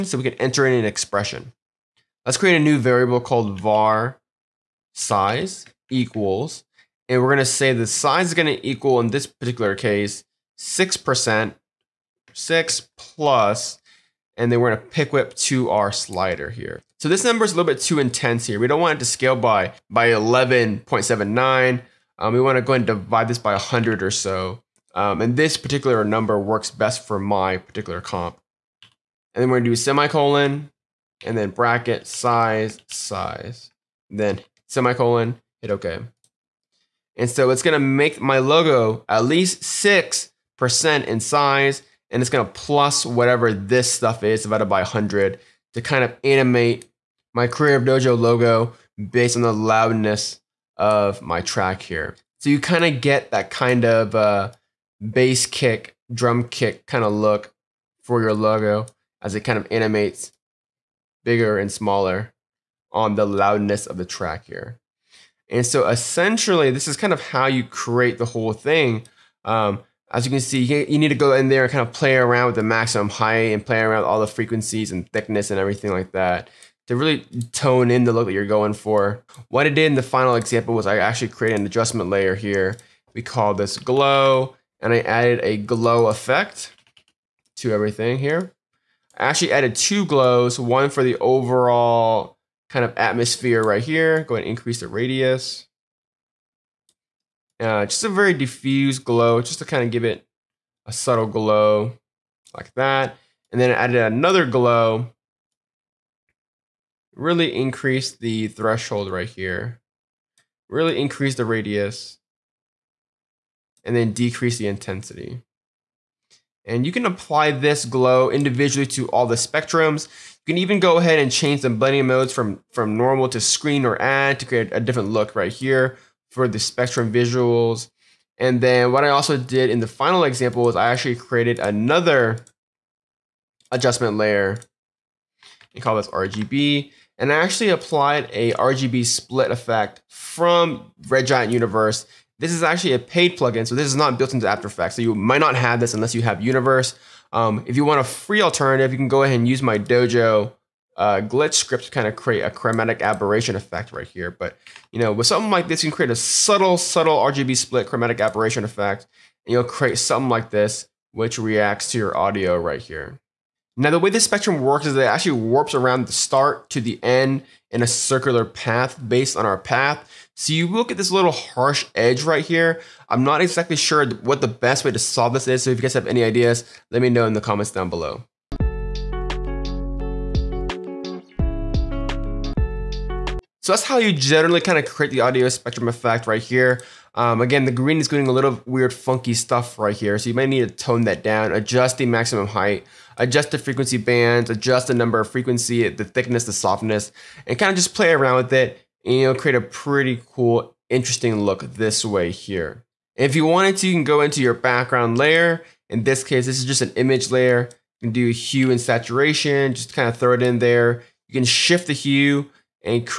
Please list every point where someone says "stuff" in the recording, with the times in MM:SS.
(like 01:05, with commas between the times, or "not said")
00:43, 03:09.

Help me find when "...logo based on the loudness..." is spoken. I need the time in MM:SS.
00:48.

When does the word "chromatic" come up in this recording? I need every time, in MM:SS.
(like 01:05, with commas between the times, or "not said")
02:32, 02:37.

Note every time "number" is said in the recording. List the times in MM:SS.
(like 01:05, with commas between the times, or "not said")
00:17, 00:26, 03:14.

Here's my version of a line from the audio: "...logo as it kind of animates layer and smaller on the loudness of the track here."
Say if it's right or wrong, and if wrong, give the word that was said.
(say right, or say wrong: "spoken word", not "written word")
wrong: "bigger", not "layer".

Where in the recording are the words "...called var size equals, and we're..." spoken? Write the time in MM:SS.
00:03.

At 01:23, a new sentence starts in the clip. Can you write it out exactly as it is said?
We call this glow and I added a glow effect to everything here.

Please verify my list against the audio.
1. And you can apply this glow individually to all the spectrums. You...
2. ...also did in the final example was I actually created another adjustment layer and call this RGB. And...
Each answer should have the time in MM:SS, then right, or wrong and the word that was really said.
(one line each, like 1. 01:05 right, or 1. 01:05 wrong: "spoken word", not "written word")
1. 01:56 right
2. 02:09 right.